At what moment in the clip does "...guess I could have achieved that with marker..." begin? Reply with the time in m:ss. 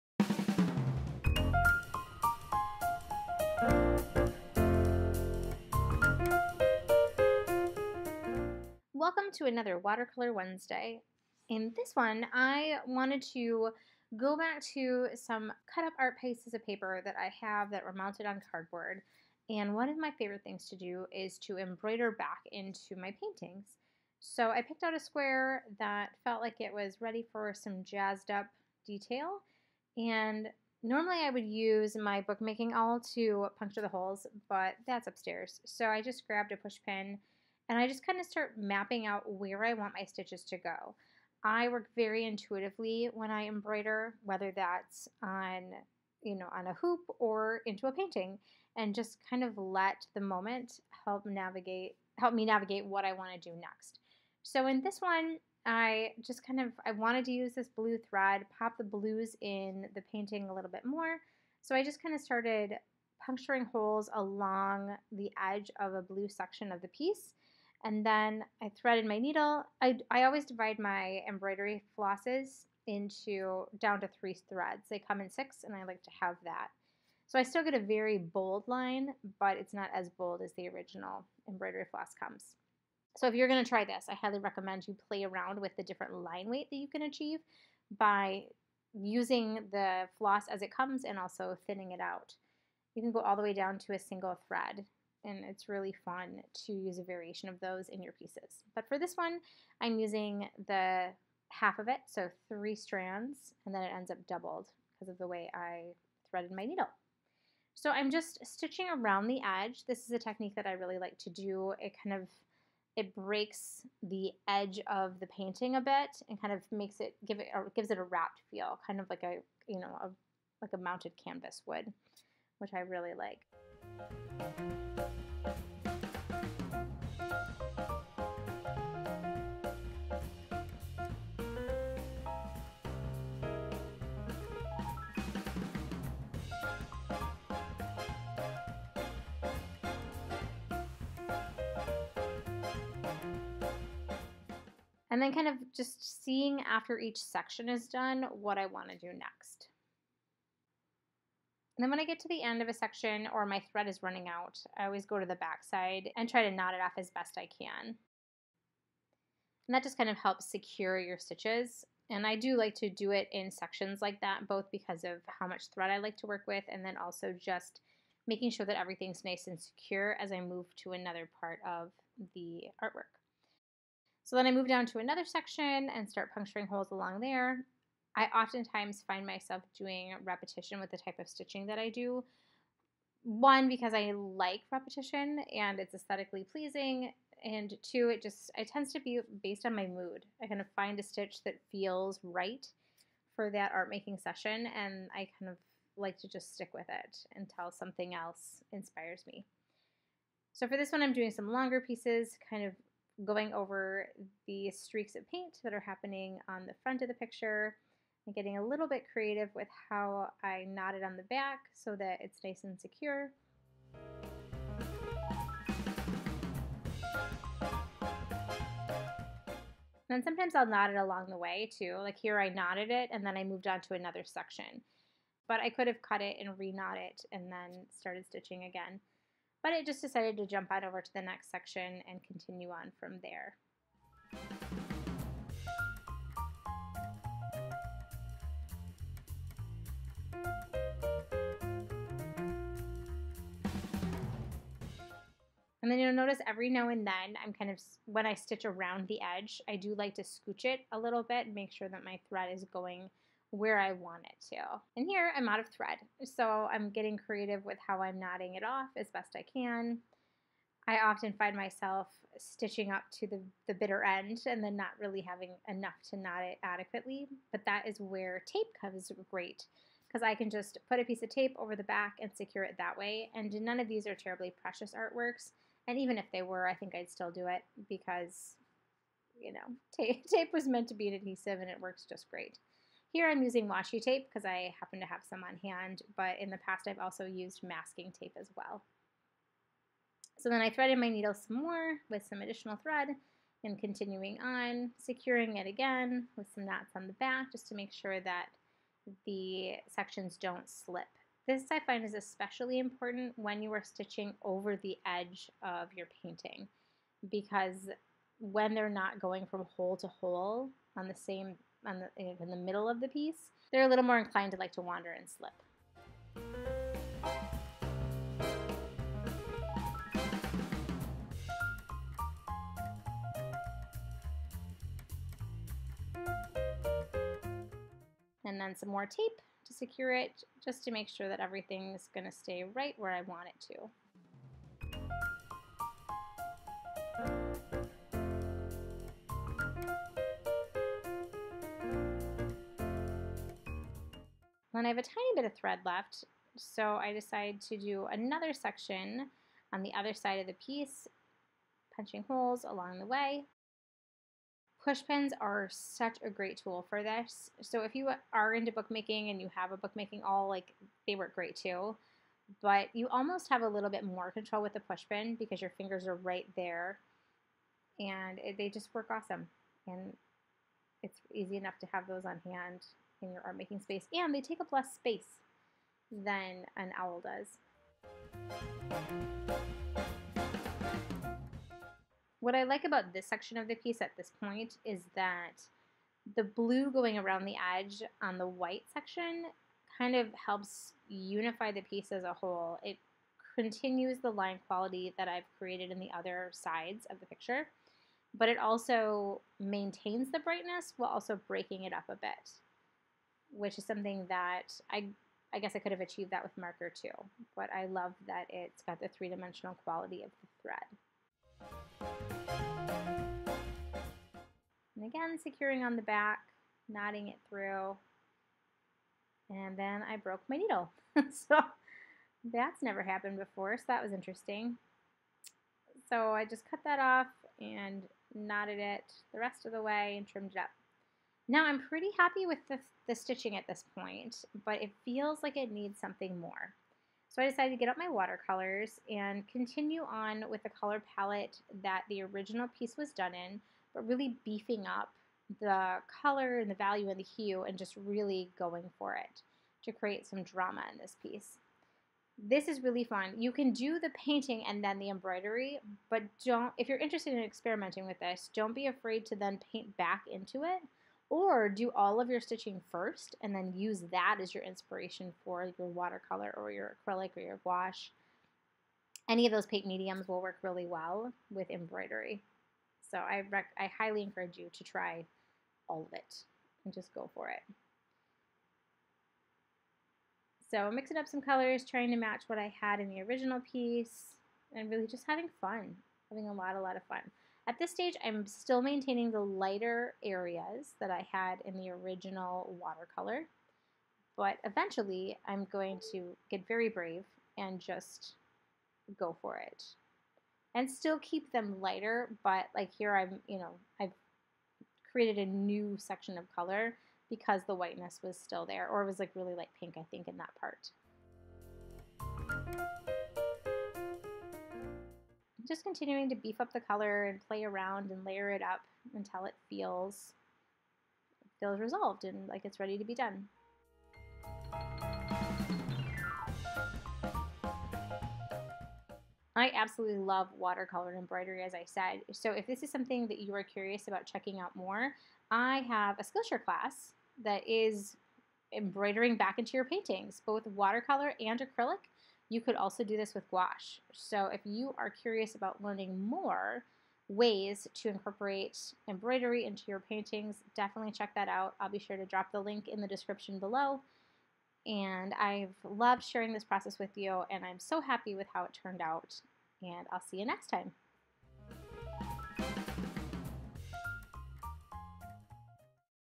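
6:45.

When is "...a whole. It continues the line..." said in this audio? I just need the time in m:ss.
6:32.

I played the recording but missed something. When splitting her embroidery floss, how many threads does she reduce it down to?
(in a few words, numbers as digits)
3.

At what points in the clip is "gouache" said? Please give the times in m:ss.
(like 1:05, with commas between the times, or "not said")
7:47, 9:03.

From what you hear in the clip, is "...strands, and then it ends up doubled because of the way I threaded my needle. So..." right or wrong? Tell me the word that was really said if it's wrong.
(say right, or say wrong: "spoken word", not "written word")
right.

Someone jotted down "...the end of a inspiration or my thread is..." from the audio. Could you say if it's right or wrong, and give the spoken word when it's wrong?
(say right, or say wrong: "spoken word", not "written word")
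wrong: "section", not "inspiration".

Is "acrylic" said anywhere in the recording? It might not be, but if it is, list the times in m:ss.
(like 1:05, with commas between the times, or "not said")
7:47, 9:01.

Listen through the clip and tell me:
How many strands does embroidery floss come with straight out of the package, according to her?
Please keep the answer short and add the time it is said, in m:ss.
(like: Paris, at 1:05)
6, at 1:15.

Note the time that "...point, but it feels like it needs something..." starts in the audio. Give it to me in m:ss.
7:13.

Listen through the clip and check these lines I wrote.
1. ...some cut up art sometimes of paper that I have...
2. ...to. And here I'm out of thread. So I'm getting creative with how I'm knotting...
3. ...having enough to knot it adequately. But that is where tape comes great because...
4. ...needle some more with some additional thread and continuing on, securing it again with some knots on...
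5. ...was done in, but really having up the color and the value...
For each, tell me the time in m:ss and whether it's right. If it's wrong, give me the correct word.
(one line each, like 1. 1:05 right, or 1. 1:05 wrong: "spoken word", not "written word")
1. 0:15 wrong: "pieces", not "sometimes"
2. 4:14 right
3. 4:25 right
4. 4:51 right
5. 7:22 wrong: "beefing", not "having".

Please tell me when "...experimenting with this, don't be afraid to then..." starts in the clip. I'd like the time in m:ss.
7:37.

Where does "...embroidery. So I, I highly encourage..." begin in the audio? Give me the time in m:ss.
7:51.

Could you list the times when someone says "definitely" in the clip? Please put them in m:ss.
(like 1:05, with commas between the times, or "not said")
9:10.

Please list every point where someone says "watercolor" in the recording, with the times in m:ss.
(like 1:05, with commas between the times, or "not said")
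0:09, 7:18, 7:45, 8:12, 8:50, 9:00.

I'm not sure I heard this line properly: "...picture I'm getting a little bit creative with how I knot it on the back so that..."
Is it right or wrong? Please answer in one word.
right.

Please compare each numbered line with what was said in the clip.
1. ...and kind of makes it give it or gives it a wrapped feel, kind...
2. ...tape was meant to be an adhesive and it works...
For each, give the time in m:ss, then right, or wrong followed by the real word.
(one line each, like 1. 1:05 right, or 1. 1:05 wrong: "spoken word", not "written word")
1. 1:56 right
2. 4:40 right.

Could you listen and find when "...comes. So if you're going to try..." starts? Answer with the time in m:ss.
1:22.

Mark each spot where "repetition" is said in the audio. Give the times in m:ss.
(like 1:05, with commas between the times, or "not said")
3:00, 3:04.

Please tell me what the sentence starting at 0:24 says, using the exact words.
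So I picked out a square that felt like it was ready for some jazzed up detail.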